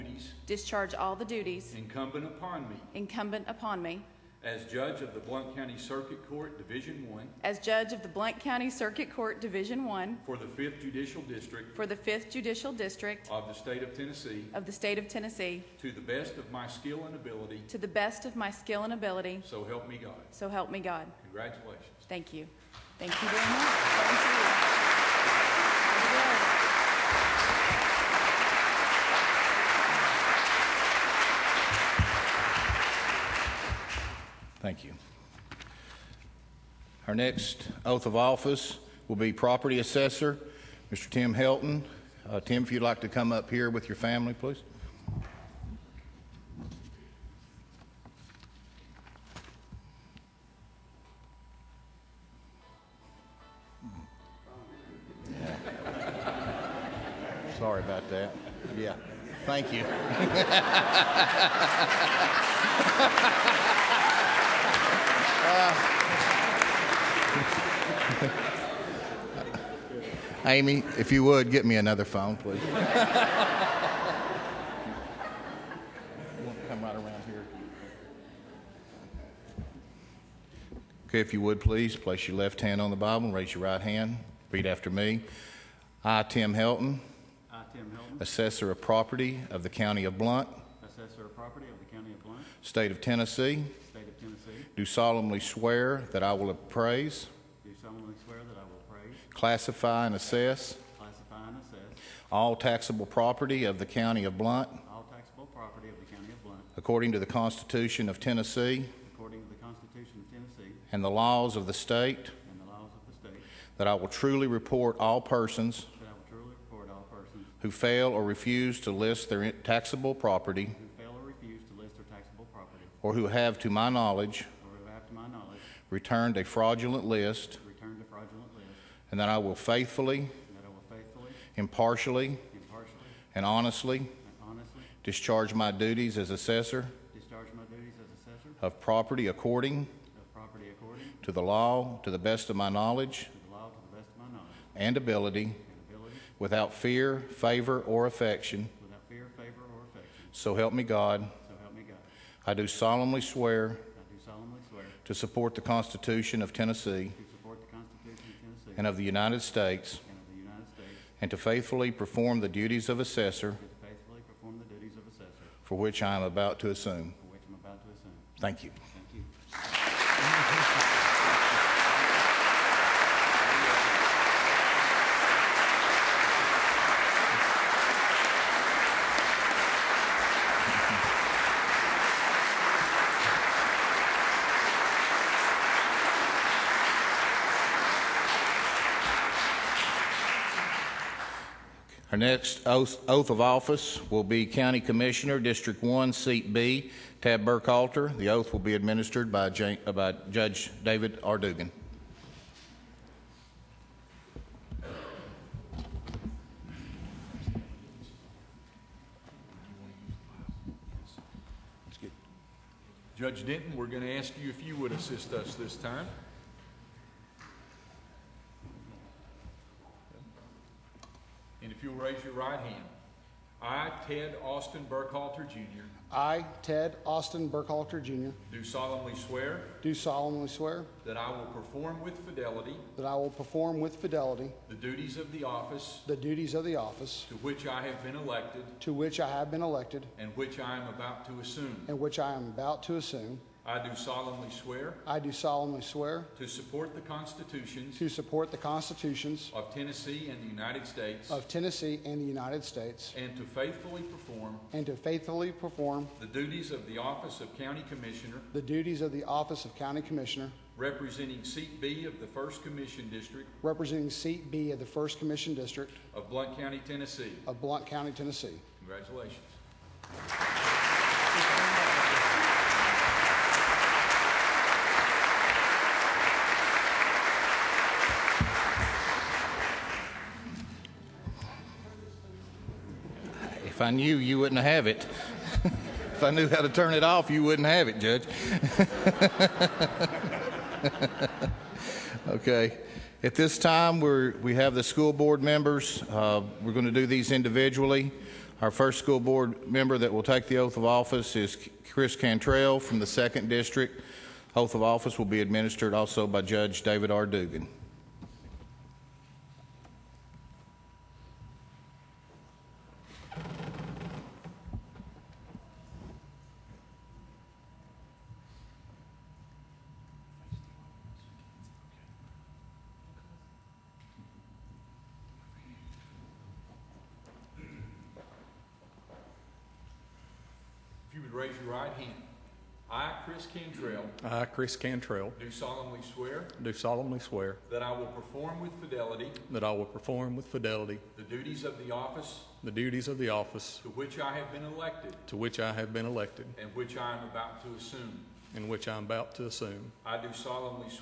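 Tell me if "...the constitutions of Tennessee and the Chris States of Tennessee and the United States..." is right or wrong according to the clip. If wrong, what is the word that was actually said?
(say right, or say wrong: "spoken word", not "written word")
wrong: "United", not "Chris".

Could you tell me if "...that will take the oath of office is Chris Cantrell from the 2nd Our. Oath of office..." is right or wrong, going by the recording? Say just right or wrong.
wrong.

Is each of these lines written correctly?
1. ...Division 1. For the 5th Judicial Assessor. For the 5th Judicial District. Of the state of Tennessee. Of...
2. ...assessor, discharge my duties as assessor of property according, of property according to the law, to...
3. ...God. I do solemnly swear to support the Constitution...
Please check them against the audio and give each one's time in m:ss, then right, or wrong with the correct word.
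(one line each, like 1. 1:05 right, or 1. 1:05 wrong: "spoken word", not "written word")
1. 0:09 wrong: "District", not "Assessor"
2. 2:16 right
3. 2:31 right.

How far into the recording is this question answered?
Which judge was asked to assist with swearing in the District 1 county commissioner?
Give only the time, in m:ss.
3:33.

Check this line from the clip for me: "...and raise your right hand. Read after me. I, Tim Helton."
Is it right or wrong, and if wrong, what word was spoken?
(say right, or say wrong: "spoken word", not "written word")
right.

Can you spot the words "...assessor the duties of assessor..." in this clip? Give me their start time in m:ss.
2:42.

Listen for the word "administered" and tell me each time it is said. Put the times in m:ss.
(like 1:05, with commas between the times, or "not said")
3:18, 5:05.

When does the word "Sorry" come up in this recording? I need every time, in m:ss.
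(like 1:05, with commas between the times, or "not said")
0:57.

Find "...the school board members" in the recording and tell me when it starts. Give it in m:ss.
4:54.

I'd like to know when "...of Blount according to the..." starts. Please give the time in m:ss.
1:46.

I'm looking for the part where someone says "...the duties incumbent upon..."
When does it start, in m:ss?
0:01.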